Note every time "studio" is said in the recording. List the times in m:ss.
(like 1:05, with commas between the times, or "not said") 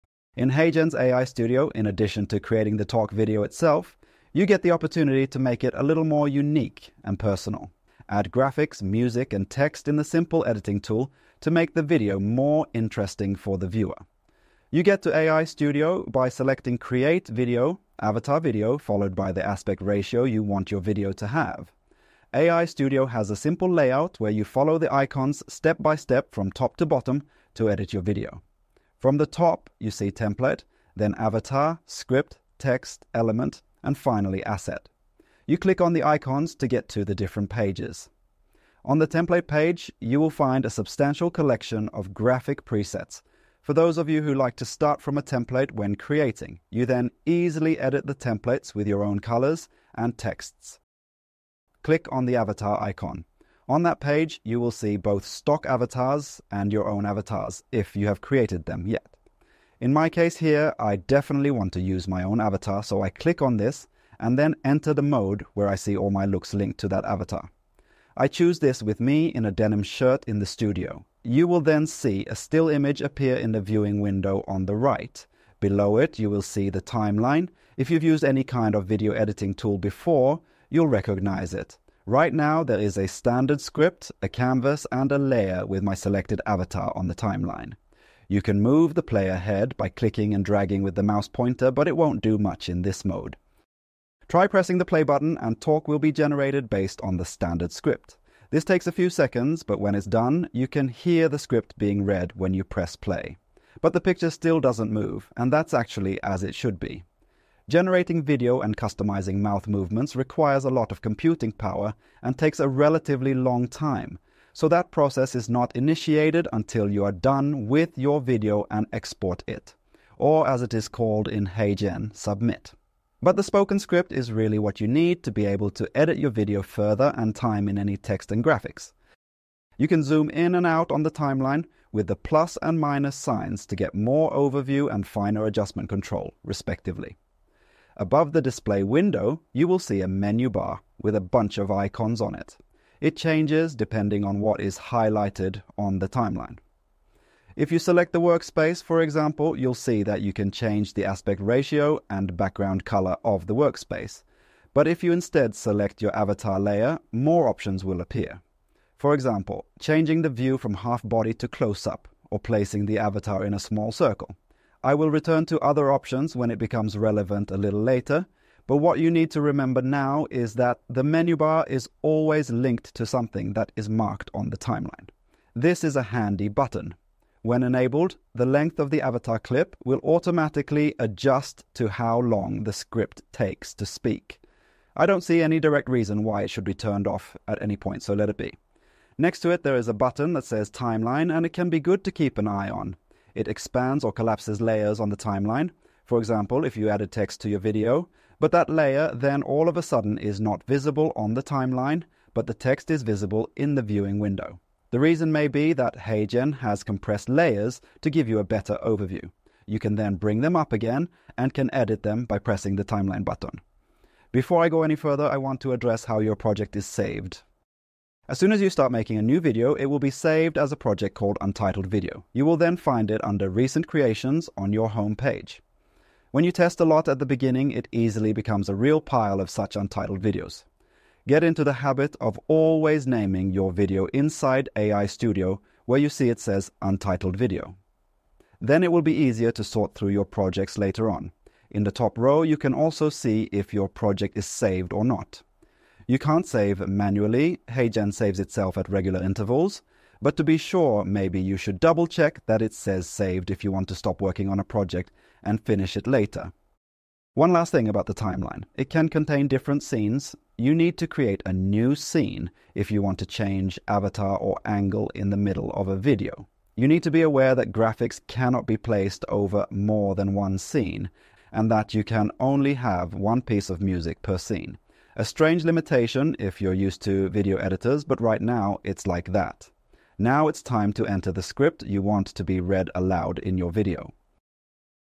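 0:01, 0:15, 0:22, 1:10, 3:55.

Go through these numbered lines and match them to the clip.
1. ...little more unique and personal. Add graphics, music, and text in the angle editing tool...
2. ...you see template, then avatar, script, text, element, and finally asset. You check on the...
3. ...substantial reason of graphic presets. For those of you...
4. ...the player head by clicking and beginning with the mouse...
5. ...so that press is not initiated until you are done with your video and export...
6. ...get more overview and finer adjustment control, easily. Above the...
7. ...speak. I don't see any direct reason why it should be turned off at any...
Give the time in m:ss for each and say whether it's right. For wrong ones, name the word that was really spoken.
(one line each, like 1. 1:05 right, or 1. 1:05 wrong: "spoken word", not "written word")
1. 0:05 wrong: "simple", not "angle"
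2. 0:29 wrong: "click", not "check"
3. 0:40 wrong: "collection", not "reason"
4. 1:28 wrong: "dragging", not "beginning"
5. 1:54 wrong: "process", not "press"
6. 2:13 wrong: "respectively", not "easily"
7. 3:03 right.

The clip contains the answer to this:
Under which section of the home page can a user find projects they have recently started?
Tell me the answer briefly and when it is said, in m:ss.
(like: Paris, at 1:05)
Recent Creations, at 3:43.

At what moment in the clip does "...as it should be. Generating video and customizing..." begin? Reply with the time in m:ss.
1:46.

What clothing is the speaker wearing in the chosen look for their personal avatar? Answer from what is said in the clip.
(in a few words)
denim shirt.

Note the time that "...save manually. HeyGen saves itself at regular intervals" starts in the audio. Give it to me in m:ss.
4:06.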